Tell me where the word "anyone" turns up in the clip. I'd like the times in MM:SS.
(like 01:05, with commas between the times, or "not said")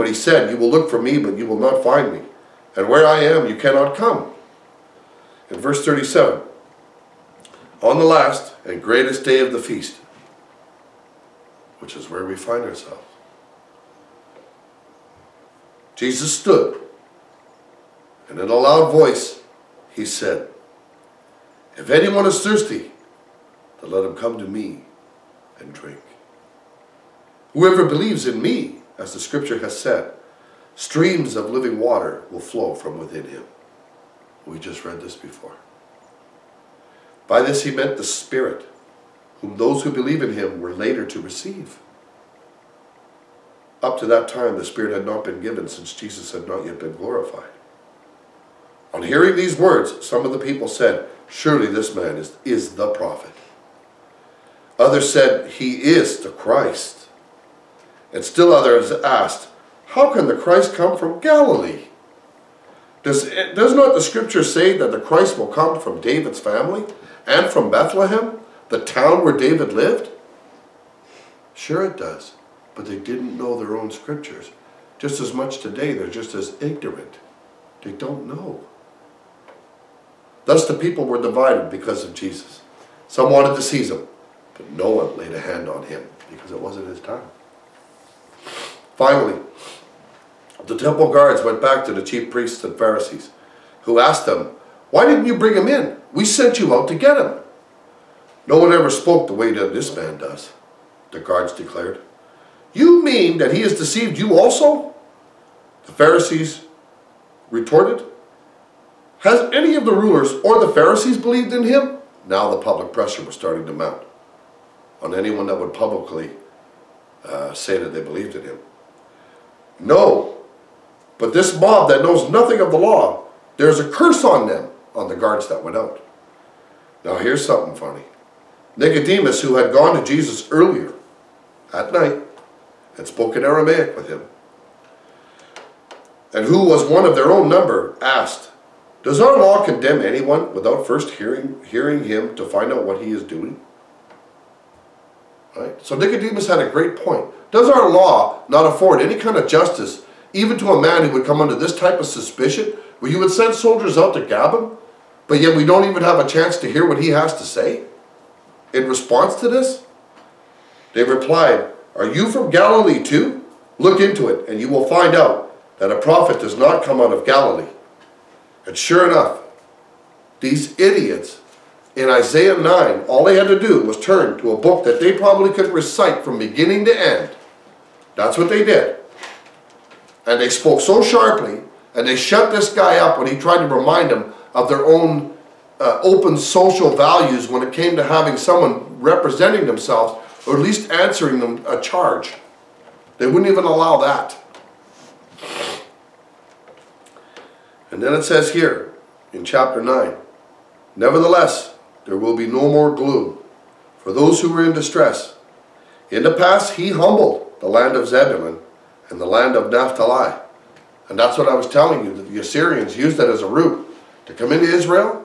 00:21, 01:55, 02:20.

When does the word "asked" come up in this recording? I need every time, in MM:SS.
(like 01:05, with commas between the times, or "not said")
00:58, 01:33, 02:17.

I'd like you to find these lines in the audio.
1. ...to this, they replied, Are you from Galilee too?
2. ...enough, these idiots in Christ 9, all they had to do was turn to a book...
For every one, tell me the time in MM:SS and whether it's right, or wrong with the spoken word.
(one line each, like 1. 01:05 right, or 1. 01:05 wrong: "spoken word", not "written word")
1. 02:39 right
2. 02:49 wrong: "Isaiah", not "Christ".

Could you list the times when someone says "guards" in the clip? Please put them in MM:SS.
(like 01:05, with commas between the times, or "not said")
01:31, 01:41, 02:05.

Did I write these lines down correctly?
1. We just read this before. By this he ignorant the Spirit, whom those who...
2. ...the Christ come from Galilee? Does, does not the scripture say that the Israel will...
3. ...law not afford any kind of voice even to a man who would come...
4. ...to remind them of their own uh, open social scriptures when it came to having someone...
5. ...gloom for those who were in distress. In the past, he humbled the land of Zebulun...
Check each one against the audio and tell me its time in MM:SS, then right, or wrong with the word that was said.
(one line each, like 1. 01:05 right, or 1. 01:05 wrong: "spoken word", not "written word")
1. 00:34 wrong: "meant", not "ignorant"
2. 01:00 wrong: "Christ", not "Israel"
3. 02:27 wrong: "justice", not "voice"
4. 03:03 wrong: "values", not "scriptures"
5. 03:22 right.